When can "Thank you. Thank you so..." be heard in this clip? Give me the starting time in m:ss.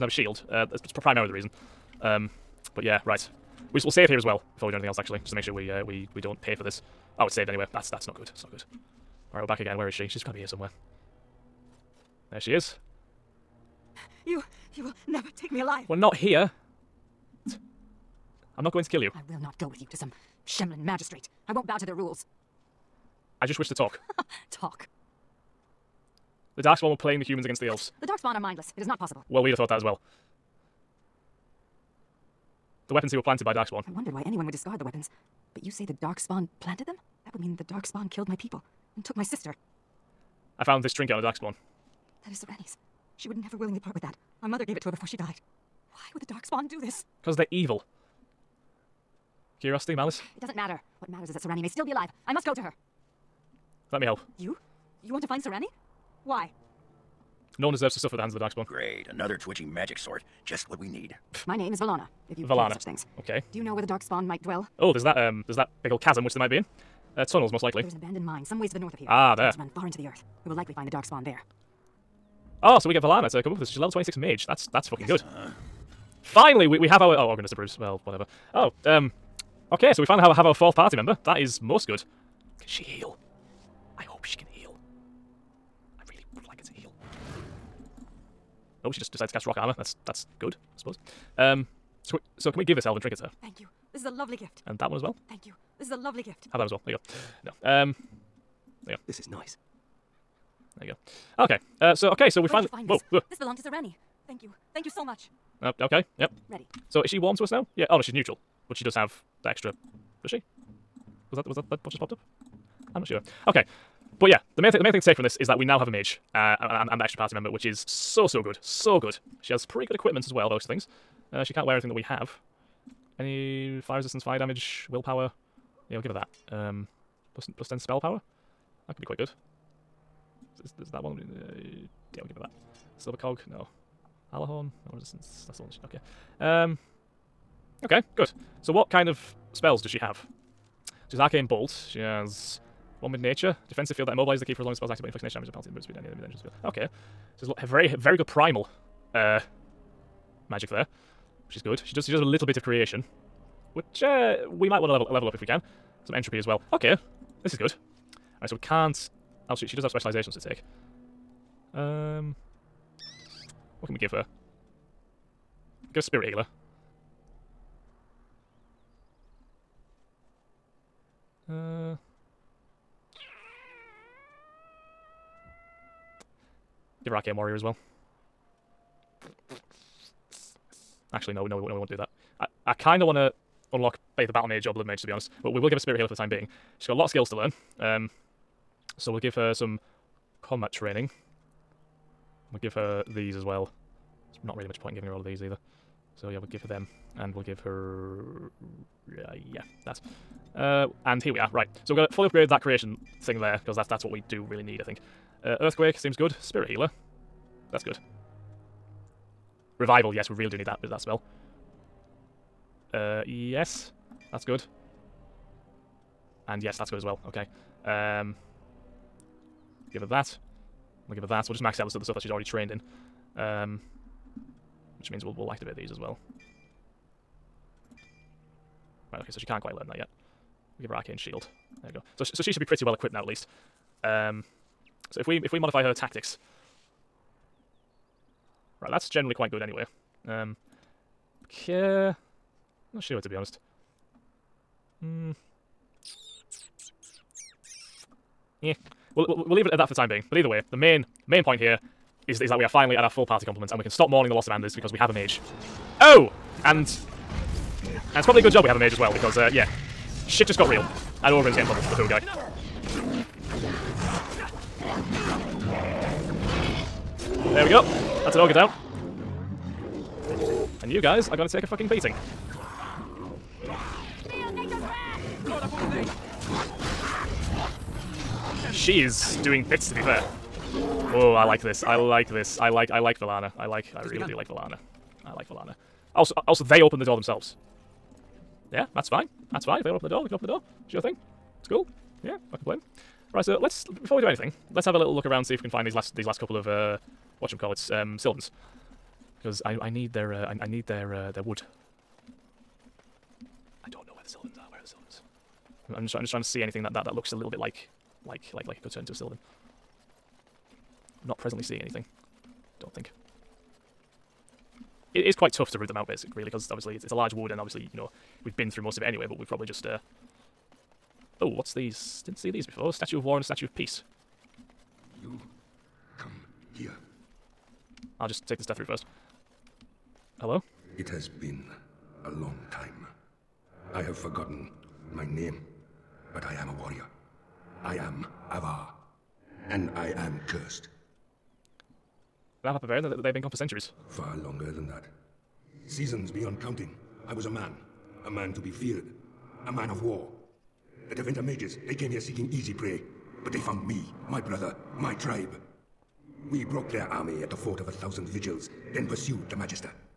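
1:44.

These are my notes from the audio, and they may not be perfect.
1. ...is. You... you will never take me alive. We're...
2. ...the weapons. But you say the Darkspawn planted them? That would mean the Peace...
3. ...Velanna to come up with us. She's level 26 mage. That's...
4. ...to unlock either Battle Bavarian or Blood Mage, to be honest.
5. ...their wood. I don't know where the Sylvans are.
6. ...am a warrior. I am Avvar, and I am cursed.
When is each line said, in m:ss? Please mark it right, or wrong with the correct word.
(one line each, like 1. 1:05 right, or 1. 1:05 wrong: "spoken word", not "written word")
1. 0:12 right
2. 0:34 wrong: "Darkspawn", not "Peace"
3. 1:13 right
4. 3:03 wrong: "Mage", not "Bavarian"
5. 5:01 right
6. 5:36 right.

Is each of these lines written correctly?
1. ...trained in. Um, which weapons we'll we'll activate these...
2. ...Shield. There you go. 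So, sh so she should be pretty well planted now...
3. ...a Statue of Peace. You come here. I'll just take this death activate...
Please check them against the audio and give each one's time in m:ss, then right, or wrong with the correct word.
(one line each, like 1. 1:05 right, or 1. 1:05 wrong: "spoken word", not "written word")
1. 3:42 wrong: "means", not "weapons"
2. 3:51 wrong: "equipped", not "planted"
3. 5:23 wrong: "route", not "activate".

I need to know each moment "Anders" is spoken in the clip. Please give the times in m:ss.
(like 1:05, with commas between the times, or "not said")
4:14.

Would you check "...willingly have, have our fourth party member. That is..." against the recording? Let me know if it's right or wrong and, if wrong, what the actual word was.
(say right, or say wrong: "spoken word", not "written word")
wrong: "finally", not "willingly".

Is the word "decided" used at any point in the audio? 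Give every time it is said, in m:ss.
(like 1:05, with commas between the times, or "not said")
1:29.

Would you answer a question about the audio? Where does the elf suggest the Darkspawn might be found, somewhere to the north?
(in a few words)
An abandoned mine.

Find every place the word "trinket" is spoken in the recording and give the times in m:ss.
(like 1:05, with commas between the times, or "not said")
0:40, 1:32.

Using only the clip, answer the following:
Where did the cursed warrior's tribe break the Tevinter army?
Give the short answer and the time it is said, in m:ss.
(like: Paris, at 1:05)
Fort of a Thousand Vigils, at 5:57.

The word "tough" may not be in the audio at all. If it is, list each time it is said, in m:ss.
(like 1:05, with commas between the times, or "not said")
5:15.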